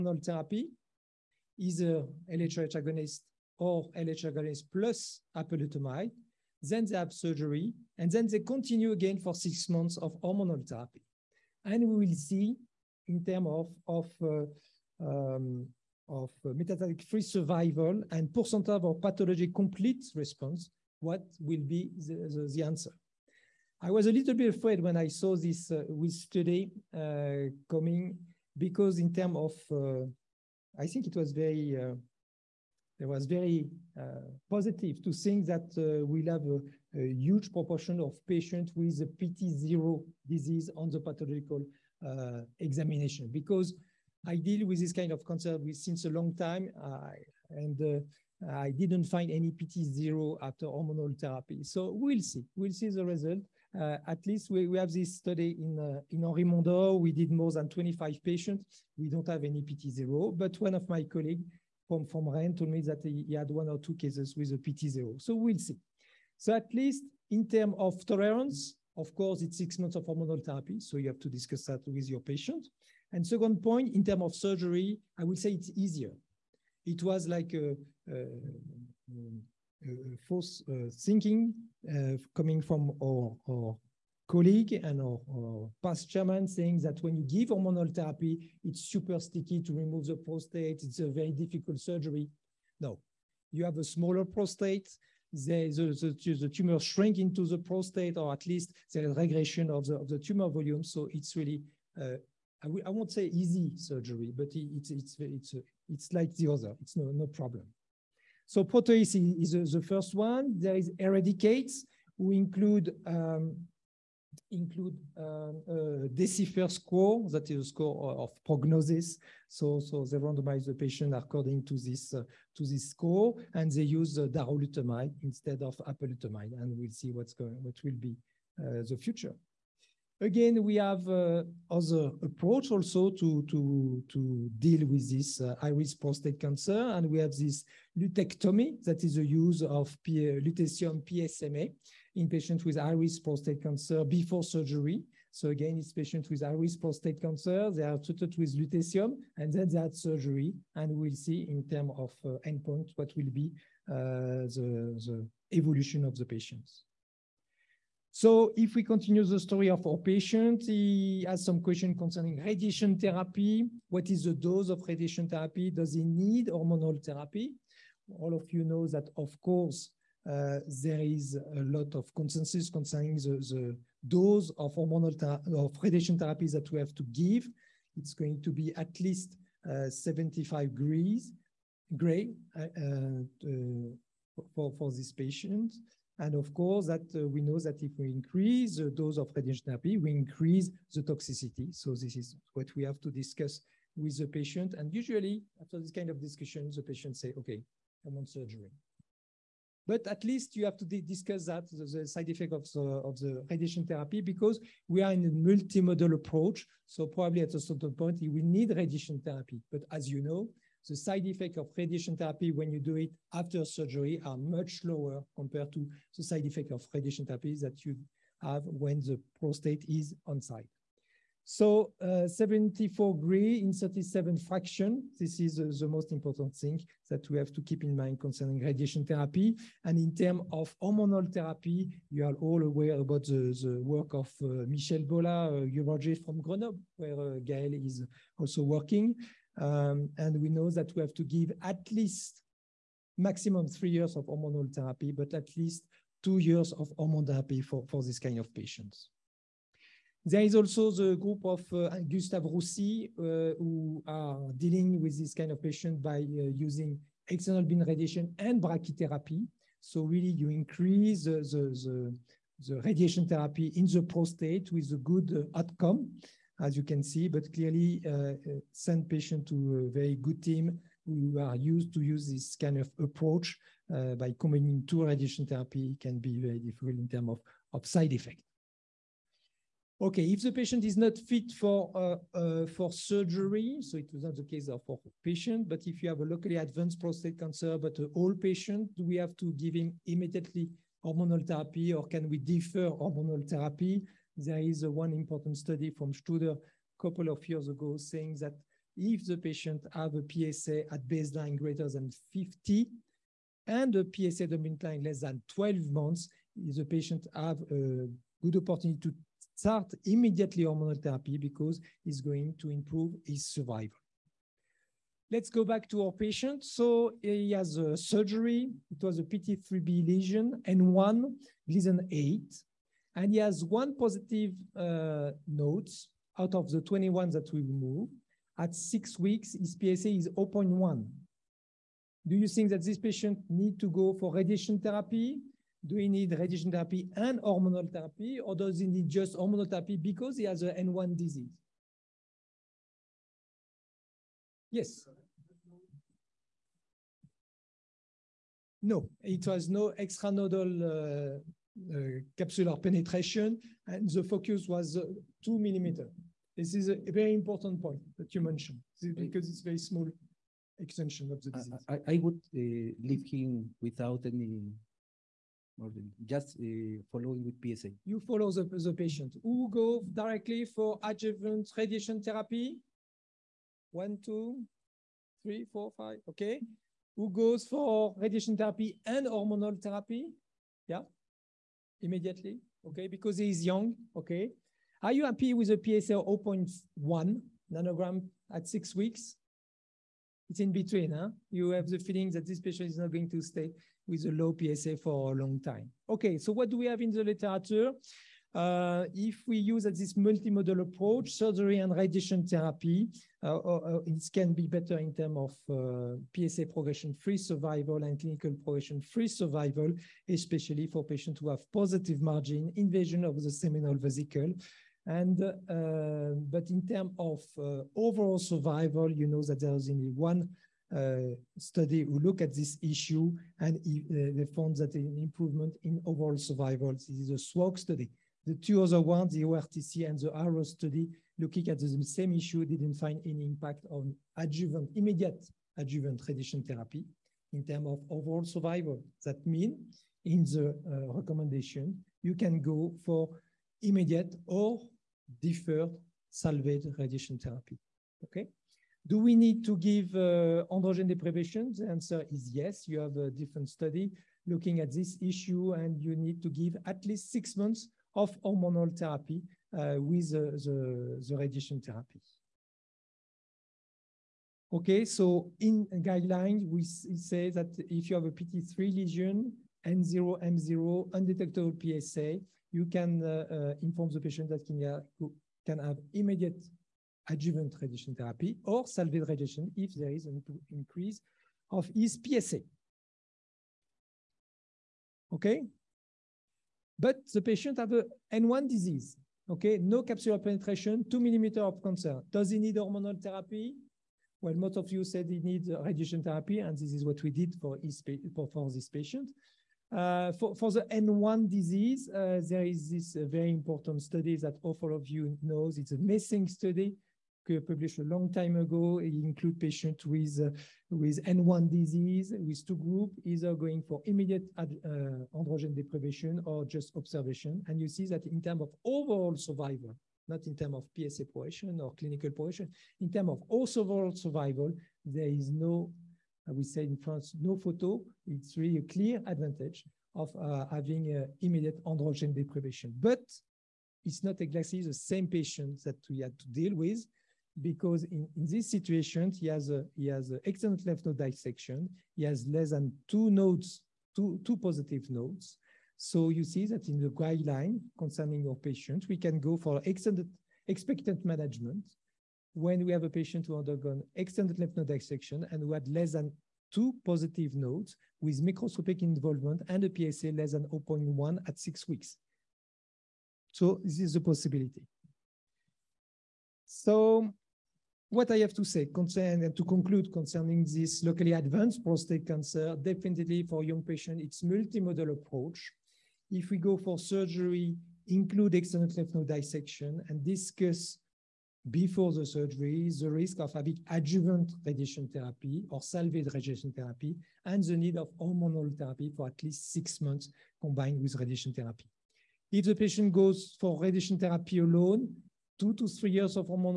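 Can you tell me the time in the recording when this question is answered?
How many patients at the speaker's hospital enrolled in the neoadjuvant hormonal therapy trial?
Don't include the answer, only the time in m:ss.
0:57.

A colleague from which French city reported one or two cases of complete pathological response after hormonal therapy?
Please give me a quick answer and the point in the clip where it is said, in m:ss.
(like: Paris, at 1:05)
Rennes, at 1:02.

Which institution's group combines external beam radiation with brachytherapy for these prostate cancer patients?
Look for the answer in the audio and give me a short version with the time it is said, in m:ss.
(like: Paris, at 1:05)
Gustave Roussy, at 4:12.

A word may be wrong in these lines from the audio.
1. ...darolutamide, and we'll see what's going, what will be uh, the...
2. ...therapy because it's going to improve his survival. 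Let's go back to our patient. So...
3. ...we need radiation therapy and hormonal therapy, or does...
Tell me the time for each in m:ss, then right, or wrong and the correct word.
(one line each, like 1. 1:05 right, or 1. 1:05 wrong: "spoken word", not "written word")
1. 2:05 wrong: "apalutamide", not "darolutamide"
2. 5:11 right
3. 5:35 right.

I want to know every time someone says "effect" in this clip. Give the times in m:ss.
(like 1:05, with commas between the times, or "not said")
3:22, 3:31, 3:36, 4:38.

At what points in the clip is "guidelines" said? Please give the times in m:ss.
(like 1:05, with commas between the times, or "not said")
7:46, 9:07.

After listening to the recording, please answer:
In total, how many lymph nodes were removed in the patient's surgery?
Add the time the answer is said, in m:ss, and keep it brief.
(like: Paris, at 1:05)
21, at 5:26.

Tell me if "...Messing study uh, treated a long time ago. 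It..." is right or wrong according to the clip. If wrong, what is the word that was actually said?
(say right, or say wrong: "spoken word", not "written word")
wrong: "published", not "treated".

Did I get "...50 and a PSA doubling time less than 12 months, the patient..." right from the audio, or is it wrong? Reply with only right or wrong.
right.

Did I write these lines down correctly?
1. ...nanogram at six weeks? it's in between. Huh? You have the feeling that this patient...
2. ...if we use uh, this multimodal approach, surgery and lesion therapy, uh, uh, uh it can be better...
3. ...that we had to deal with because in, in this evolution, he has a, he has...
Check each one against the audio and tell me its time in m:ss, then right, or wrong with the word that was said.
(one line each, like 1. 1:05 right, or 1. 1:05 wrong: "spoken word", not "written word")
1. 6:27 right
2. 6:39 wrong: "radiation", not "lesion"
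3. 8:55 wrong: "situation", not "evolution".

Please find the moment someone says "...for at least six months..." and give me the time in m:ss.
9:49.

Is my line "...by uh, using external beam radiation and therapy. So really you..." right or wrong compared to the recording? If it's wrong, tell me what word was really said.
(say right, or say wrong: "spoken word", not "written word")
wrong: "brachytherapy", not "therapy".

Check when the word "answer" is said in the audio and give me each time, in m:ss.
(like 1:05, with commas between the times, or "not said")
0:22, 7:31.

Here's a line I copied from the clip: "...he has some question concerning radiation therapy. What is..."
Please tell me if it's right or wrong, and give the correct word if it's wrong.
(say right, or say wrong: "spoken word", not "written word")
right.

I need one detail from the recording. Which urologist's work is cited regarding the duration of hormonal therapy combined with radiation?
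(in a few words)
Michel Bolla.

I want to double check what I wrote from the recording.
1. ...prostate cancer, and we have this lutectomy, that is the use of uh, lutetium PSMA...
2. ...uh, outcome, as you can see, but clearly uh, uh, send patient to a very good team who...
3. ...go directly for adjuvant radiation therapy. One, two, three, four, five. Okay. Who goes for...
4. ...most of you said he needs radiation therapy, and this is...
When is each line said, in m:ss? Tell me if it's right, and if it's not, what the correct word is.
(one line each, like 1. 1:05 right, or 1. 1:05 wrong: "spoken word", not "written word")
1. 2:15 right
2. 4:25 right
3. 6:09 right
4. 8:14 right.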